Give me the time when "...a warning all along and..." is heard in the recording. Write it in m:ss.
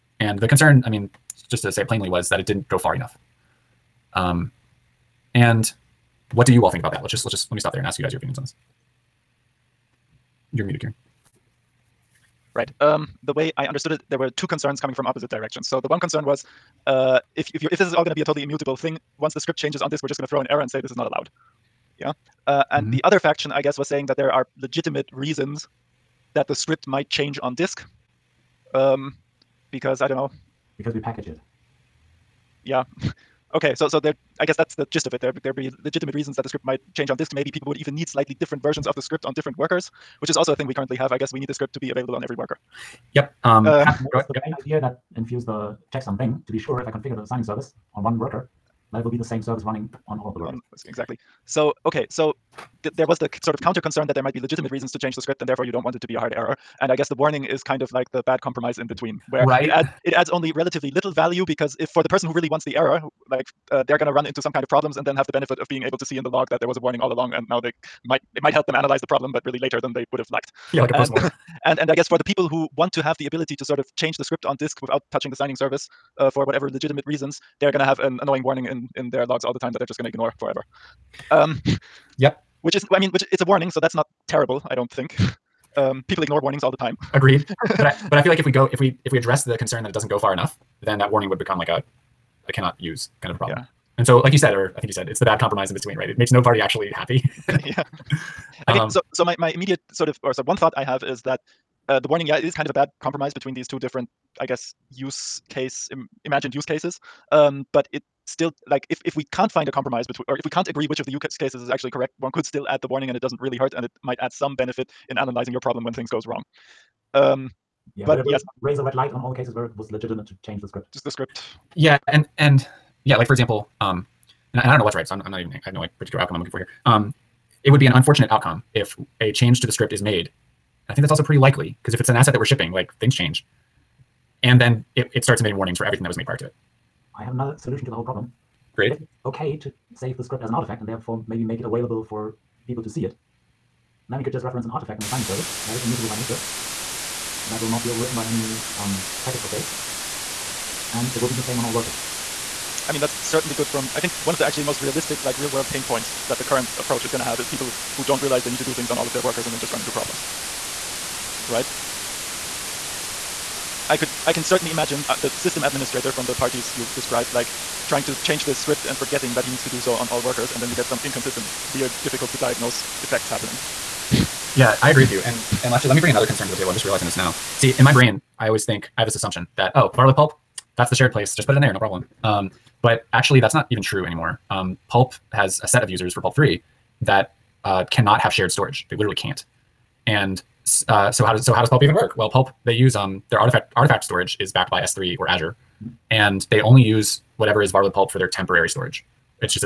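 1:06.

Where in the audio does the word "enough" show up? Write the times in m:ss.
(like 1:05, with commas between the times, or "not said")
0:02, 1:30.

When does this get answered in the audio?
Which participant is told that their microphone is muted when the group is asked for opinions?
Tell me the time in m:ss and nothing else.
0:10.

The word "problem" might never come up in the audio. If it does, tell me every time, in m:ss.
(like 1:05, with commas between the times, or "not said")
1:04, 1:09, 1:33, 1:55, 2:18, 2:39, 3:01.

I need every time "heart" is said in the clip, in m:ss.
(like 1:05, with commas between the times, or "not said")
not said.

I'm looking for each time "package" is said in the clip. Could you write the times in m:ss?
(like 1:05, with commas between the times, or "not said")
0:30, 2:29.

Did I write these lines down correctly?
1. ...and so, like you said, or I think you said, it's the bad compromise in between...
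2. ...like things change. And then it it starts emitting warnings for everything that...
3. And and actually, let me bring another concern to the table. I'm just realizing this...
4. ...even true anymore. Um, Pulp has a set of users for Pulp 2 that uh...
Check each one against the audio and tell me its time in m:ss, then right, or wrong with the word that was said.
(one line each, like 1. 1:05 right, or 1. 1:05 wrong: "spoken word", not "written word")
1. 1:33 right
2. 2:12 right
3. 2:55 right
4. 3:03 wrong: "3", not "2".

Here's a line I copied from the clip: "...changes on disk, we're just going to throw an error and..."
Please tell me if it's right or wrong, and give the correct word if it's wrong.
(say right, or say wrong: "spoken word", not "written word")
right.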